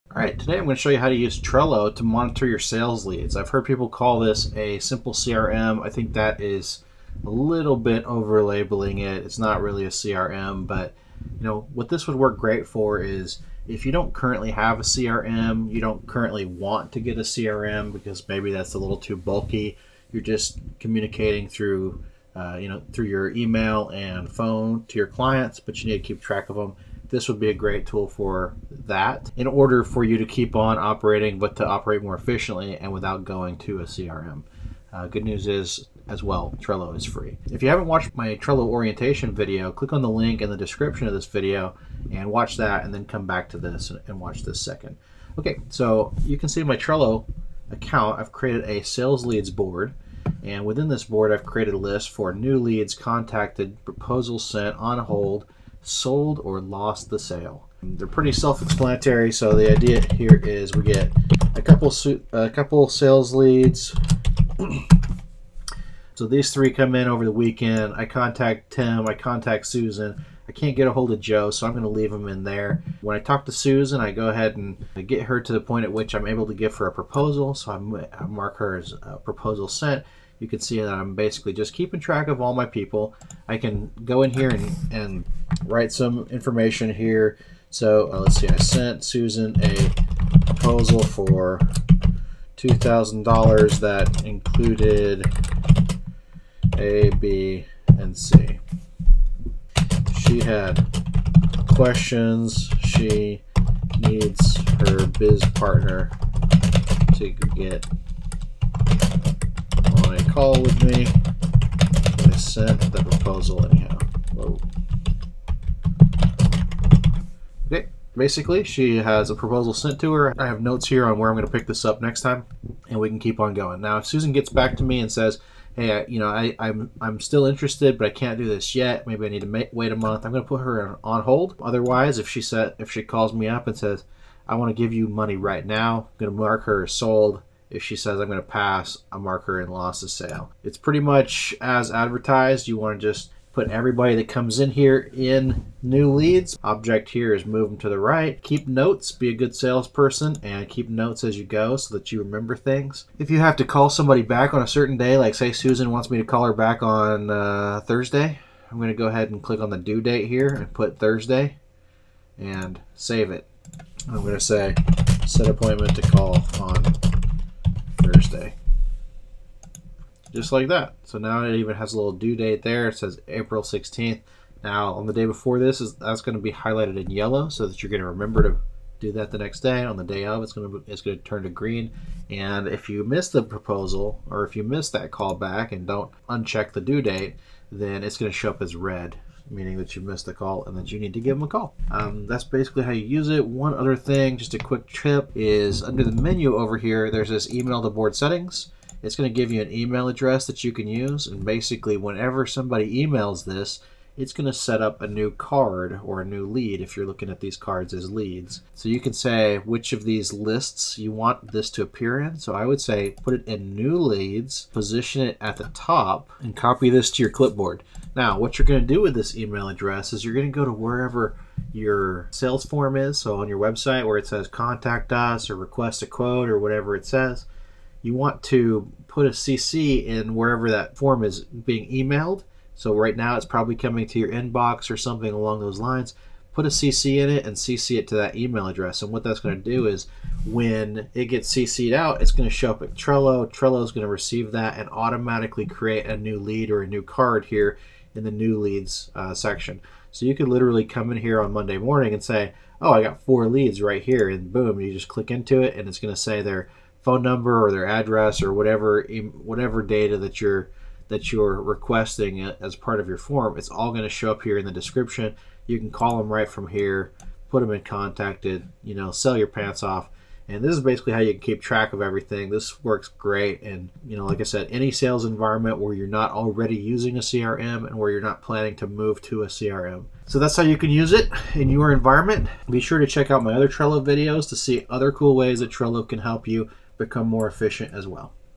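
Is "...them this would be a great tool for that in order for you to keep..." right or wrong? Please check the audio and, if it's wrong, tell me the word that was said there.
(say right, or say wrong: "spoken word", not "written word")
right.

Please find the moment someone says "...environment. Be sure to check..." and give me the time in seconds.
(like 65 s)
281 s.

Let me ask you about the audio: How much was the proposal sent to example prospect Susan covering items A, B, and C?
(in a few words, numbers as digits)
$2,000.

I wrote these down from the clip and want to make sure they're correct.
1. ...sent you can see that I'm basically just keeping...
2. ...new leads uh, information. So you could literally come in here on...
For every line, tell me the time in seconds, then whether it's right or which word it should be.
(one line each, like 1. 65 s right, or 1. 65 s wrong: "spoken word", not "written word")
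1. 79 s right
2. 248 s wrong: "section", not "information".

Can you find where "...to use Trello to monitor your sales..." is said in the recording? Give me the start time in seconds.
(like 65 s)
1 s.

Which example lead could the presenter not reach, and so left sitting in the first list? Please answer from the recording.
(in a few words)
Joe.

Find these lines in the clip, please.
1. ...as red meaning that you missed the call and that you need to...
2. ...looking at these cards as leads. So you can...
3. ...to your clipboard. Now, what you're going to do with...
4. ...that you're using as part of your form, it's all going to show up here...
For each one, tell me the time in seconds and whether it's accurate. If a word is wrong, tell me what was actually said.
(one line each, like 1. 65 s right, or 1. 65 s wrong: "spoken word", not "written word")
1. 188 s right
2. 207 s right
3. 217 s right
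4. 261 s wrong: "requesting", not "using".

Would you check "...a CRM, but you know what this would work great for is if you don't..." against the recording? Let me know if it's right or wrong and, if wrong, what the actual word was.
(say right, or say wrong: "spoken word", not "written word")
right.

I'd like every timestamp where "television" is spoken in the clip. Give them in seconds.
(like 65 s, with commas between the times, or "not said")
not said.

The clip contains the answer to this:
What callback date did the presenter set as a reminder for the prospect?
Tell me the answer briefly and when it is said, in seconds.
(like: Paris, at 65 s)
April 16th, at 173 s.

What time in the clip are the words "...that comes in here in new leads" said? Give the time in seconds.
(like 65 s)
144 s.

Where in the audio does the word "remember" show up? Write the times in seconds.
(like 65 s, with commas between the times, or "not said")
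152 s, 178 s.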